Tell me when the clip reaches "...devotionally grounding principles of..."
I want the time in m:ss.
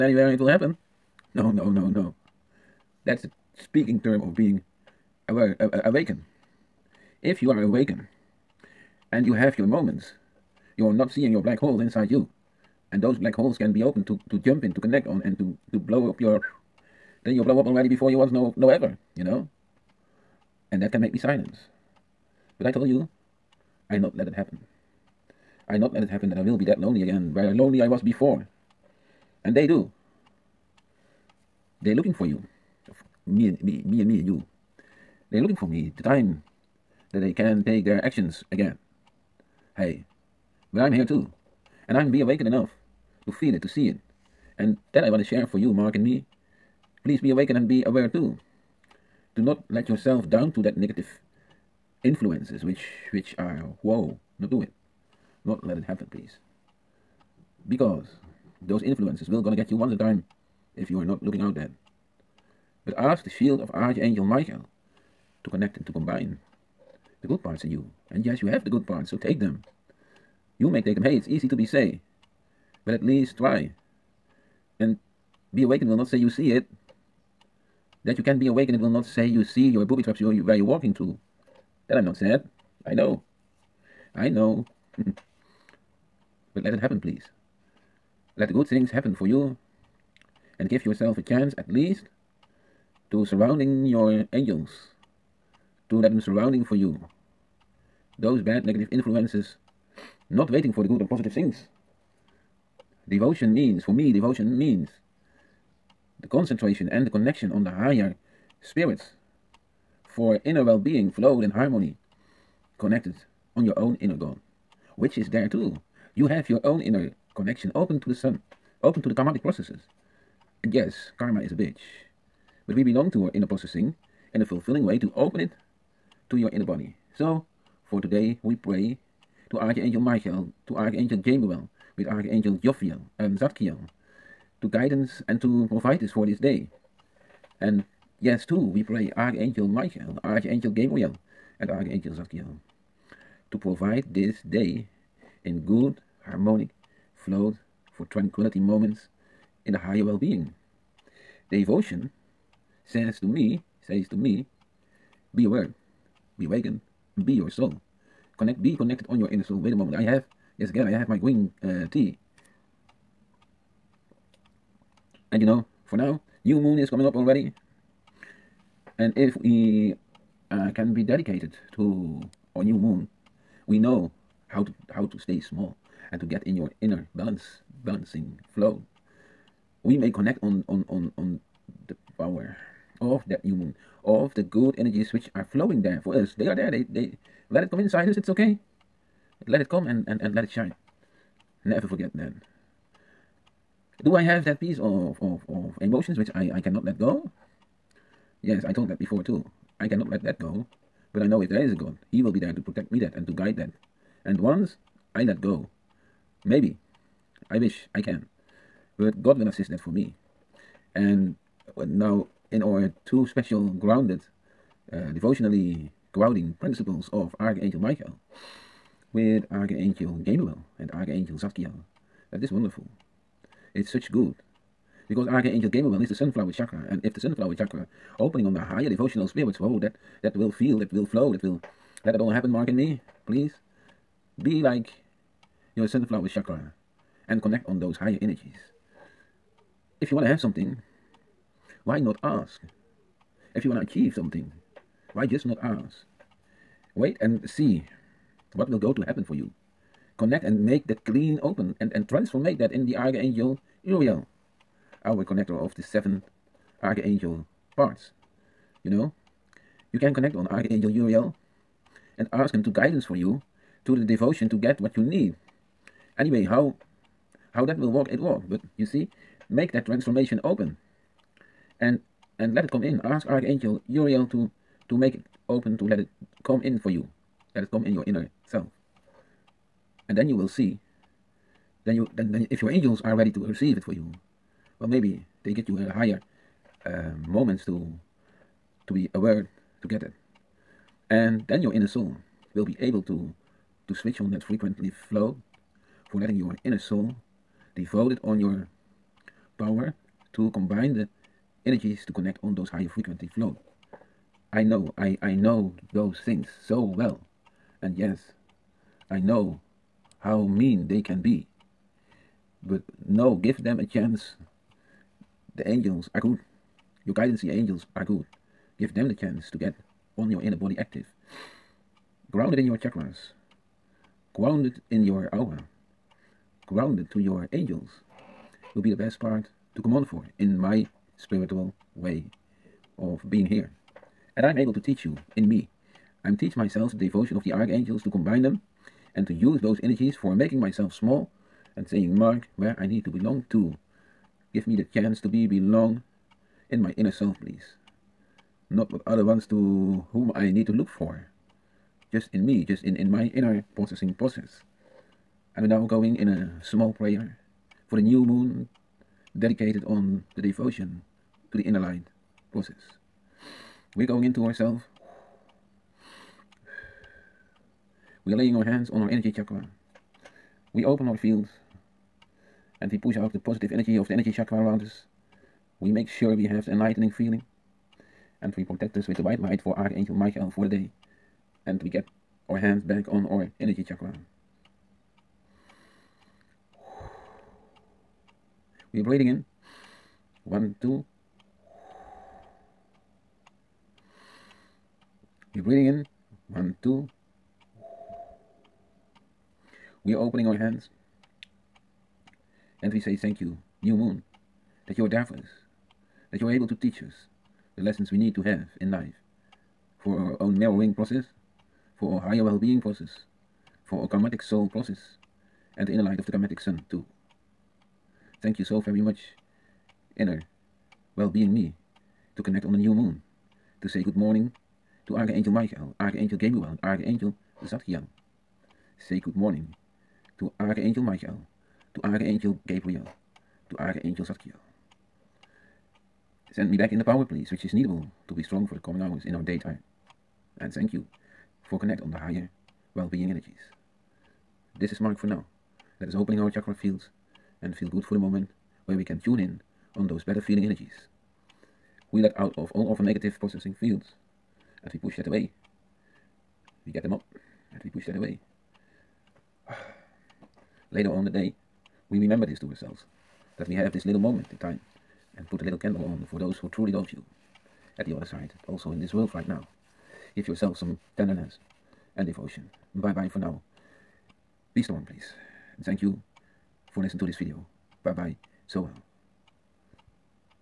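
3:35.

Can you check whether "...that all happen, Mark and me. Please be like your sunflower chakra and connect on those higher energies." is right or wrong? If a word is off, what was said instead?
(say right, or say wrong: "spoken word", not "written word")
right.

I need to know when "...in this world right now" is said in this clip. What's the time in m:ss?
7:48.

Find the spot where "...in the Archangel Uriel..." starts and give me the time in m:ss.
4:12.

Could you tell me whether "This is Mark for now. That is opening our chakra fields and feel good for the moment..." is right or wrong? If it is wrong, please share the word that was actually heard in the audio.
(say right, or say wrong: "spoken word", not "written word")
right.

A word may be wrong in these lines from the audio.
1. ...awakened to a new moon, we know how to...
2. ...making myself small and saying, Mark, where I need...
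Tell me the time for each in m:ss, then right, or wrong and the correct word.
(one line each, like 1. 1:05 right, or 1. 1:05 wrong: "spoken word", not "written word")
1. 2:51 wrong: "dedicated", not "awakened"
2. 5:40 right.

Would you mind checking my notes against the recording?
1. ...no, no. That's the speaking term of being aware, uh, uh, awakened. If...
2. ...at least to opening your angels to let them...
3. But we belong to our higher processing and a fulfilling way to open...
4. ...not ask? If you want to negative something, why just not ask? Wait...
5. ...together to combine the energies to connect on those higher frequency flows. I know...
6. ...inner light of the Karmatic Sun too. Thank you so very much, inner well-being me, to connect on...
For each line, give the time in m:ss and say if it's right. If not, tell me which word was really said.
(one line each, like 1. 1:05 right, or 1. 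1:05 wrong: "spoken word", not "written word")
1. 0:01 right
2. 1:31 wrong: "surrounding", not "opening"
3. 2:02 wrong: "inner", not "higher"
4. 4:02 wrong: "achieve", not "negative"
5. 4:59 wrong: "power", not "together"
6. 6:55 right.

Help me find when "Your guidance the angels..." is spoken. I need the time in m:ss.
5:17.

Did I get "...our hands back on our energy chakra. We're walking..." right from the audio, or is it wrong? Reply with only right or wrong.
wrong.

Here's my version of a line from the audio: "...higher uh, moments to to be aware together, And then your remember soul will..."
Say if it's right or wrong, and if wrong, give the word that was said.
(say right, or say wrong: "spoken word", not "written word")
wrong: "inner", not "remember".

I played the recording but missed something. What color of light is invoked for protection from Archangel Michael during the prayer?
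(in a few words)
white.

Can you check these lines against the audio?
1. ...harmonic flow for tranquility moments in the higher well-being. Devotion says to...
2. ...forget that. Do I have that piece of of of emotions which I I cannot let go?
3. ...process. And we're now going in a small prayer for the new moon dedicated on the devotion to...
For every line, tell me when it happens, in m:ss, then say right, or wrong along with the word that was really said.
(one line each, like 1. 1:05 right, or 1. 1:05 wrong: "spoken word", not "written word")
1. 2:26 right
2. 3:11 right
3. 5:54 right.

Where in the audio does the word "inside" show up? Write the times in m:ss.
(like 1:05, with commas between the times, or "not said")
0:11, 3:07.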